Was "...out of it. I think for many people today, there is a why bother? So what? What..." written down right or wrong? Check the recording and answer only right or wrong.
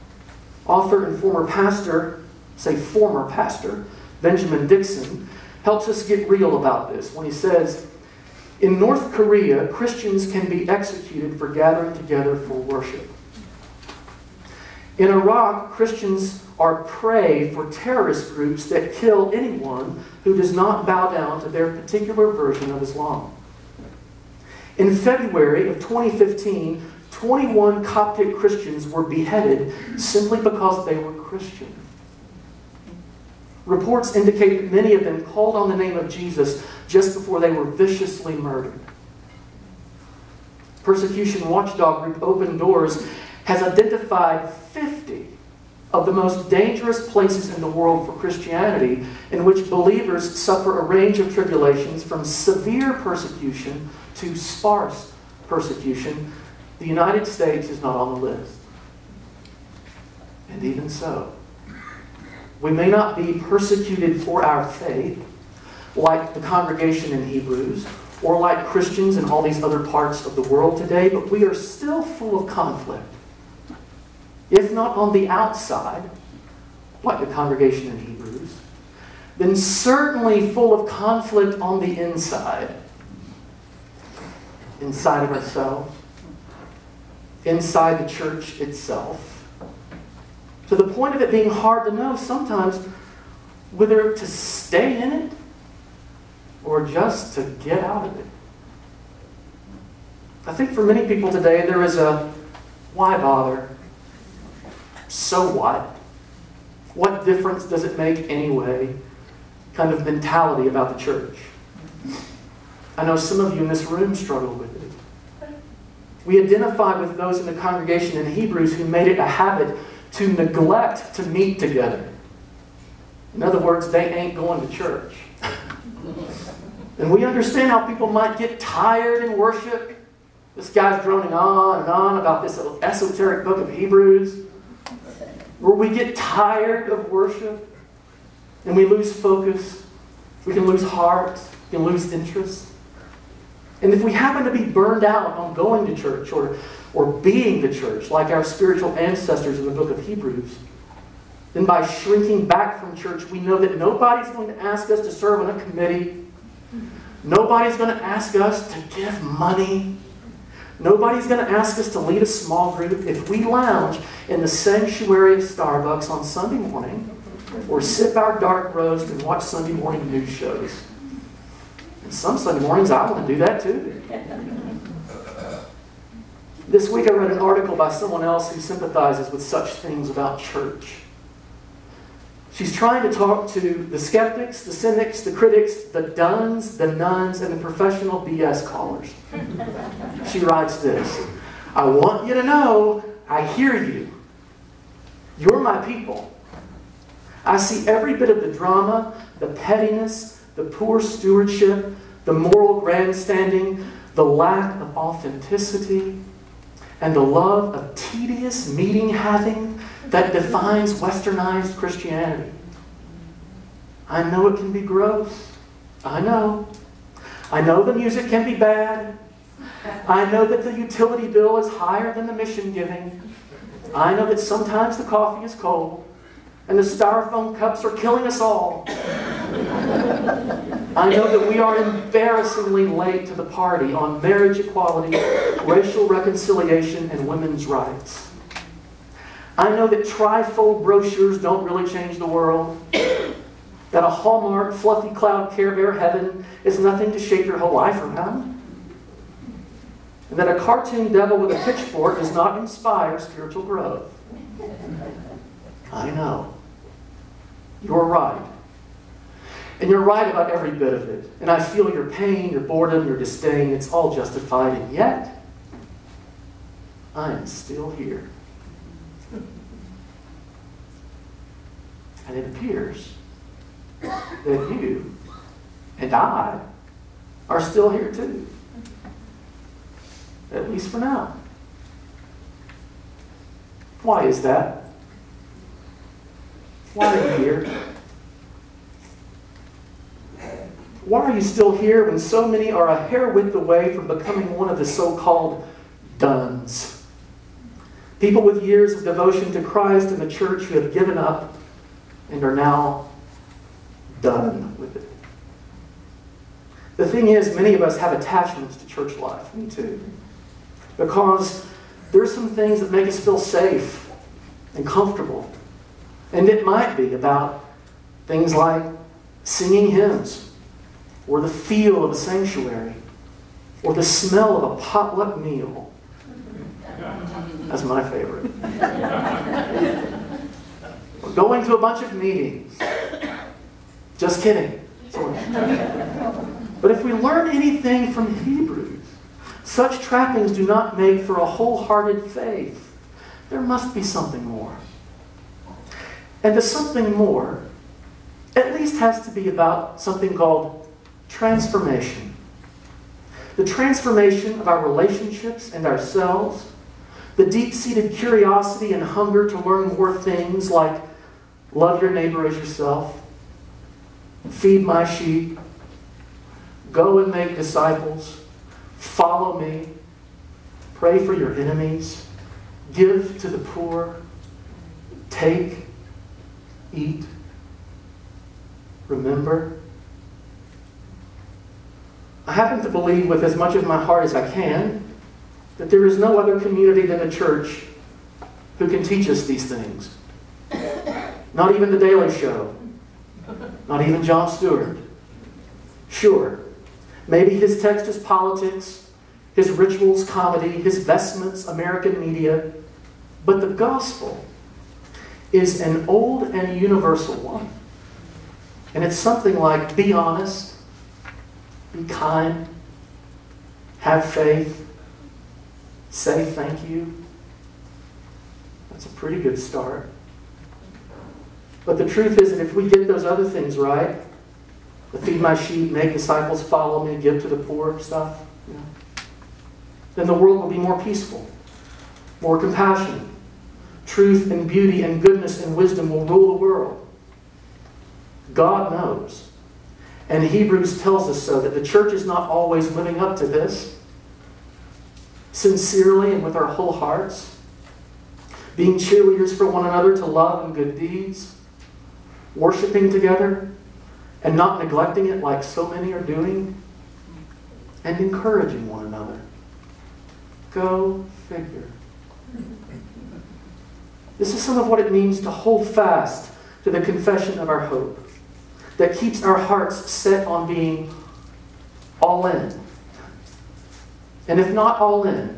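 right.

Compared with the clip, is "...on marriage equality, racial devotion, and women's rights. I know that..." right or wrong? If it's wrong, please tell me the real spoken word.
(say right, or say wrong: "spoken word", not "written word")
wrong: "reconciliation", not "devotion".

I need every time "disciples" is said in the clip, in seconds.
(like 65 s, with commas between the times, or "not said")
367 s, 426 s.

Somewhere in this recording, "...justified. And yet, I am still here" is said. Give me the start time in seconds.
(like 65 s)
264 s.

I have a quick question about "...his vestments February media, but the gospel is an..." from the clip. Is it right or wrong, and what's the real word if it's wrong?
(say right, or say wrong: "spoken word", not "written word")
wrong: "American", not "February".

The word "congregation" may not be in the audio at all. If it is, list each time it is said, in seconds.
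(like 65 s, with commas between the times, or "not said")
66 s, 77 s, 117 s.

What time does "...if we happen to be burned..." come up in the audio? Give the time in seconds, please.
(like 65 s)
143 s.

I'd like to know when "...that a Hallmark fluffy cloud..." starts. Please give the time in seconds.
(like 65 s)
242 s.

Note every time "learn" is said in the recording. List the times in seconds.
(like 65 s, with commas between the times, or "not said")
337 s, 359 s.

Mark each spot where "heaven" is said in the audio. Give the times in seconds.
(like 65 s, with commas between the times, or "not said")
245 s.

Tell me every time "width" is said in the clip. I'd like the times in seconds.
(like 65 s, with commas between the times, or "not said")
293 s.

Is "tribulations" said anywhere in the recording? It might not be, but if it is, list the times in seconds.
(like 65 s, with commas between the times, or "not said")
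51 s.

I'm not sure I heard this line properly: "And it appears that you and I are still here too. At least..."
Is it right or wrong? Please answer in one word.
right.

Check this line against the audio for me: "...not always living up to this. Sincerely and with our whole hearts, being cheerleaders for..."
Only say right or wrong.
right.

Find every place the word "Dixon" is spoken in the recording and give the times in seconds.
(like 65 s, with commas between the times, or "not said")
4 s.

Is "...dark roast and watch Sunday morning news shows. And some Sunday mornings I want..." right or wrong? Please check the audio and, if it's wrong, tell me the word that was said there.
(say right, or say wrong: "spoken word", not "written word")
right.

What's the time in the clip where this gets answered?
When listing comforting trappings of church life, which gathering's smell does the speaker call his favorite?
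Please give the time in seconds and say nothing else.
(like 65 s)
324 s.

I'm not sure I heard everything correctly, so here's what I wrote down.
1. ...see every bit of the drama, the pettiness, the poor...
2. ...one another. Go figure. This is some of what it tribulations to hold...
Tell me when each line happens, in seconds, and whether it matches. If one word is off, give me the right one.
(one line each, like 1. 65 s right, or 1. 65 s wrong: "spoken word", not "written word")
1. 197 s right
2. 458 s wrong: "means", not "tribulations".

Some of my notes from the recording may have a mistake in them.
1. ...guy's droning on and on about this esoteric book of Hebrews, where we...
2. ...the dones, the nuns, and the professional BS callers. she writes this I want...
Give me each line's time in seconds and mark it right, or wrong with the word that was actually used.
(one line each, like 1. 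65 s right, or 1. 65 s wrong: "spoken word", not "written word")
1. 130 s right
2. 185 s right.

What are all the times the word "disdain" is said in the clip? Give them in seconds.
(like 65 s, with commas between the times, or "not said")
263 s.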